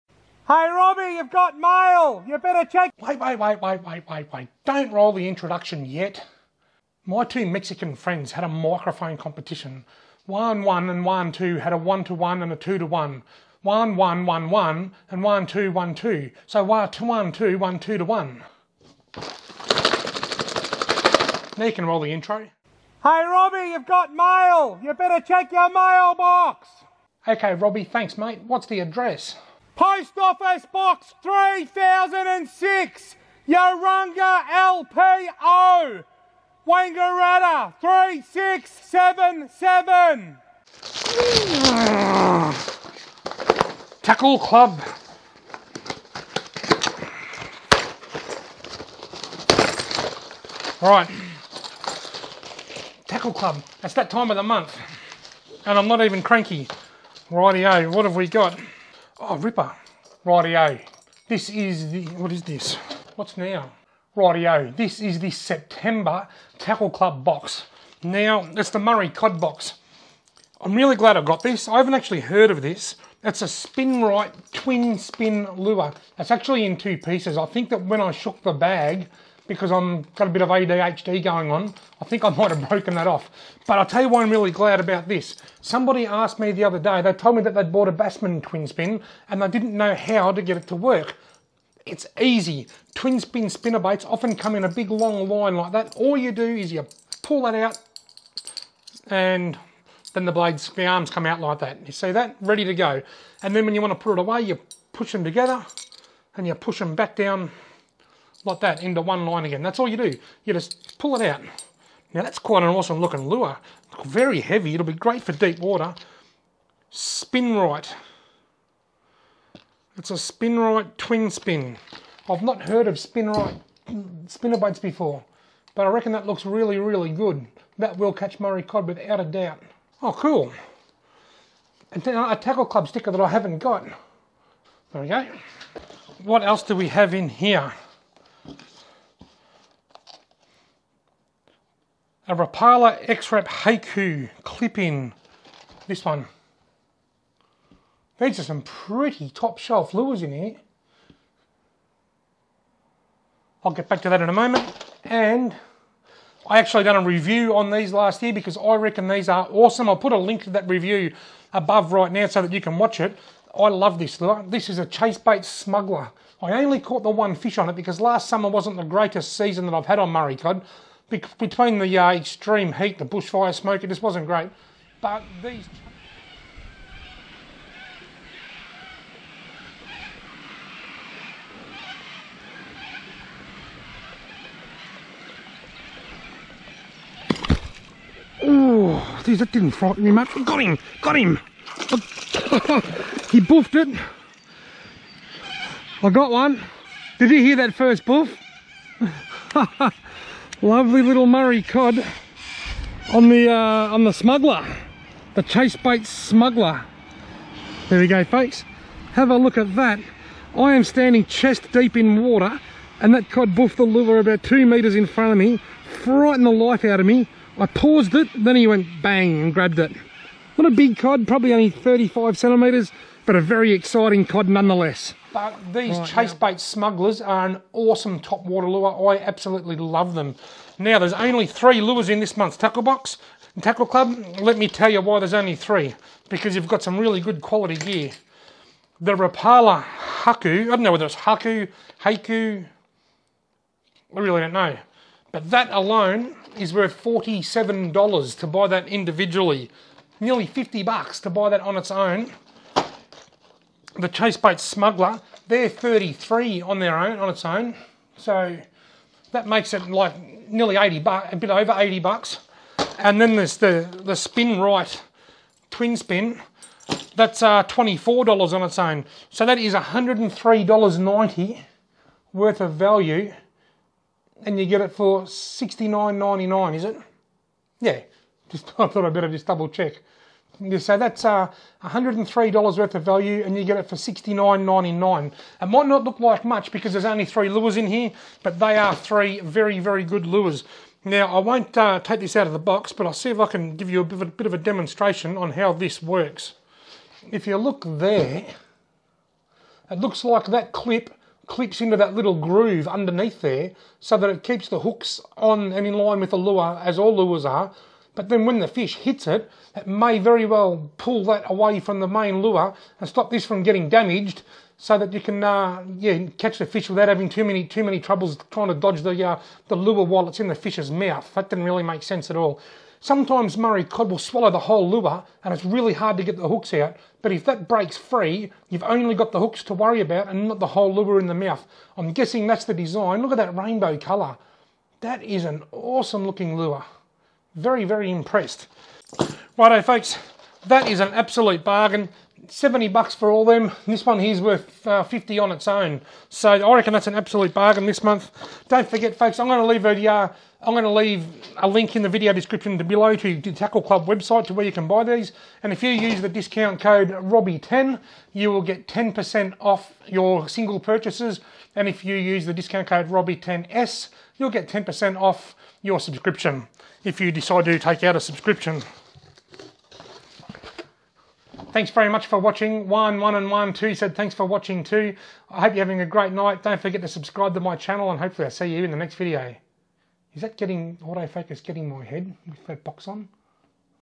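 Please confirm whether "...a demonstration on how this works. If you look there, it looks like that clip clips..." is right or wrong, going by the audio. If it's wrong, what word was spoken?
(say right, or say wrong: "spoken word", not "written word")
right.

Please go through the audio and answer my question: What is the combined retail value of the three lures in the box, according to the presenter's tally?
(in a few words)
$103.90.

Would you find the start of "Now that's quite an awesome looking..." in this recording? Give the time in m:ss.
1:52.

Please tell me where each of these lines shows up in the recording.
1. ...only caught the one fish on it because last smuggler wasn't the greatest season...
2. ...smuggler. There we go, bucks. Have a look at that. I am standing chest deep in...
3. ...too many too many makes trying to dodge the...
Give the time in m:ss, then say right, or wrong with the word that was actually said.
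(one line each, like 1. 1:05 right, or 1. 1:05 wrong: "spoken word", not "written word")
1. 2:46 wrong: "summer", not "smuggler"
2. 3:26 wrong: "folks", not "bucks"
3. 5:17 wrong: "troubles", not "makes".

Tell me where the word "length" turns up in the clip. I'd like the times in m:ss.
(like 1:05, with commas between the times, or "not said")
not said.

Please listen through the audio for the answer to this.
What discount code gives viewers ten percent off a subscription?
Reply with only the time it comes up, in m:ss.
6:03.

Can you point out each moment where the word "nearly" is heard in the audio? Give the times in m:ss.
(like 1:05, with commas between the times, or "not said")
4:10, 4:20.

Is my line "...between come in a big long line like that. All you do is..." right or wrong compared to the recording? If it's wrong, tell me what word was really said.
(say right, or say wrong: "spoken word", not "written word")
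wrong: "often", not "between".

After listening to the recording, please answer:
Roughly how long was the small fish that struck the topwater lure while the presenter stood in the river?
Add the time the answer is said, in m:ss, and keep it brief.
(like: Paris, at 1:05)
35 centimetres, at 3:41.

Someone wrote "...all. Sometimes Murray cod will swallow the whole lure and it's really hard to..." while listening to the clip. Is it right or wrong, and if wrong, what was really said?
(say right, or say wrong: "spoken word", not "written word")
right.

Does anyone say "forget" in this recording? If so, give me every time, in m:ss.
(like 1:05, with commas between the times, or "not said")
5:48, 6:16.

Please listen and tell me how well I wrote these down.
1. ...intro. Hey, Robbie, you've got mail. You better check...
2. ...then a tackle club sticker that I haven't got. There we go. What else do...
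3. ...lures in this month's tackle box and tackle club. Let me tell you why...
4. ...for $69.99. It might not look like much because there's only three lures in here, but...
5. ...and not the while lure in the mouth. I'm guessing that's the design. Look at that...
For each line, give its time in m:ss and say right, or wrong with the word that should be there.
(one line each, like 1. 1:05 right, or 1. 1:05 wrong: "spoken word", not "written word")
1. 0:22 right
2. 2:12 right
3. 3:51 right
4. 4:43 right
5. 5:30 wrong: "whole", not "while".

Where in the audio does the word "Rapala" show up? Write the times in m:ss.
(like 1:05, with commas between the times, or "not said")
2:22, 3:59.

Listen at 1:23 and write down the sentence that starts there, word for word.
But I'll tell you why I'm really glad about this.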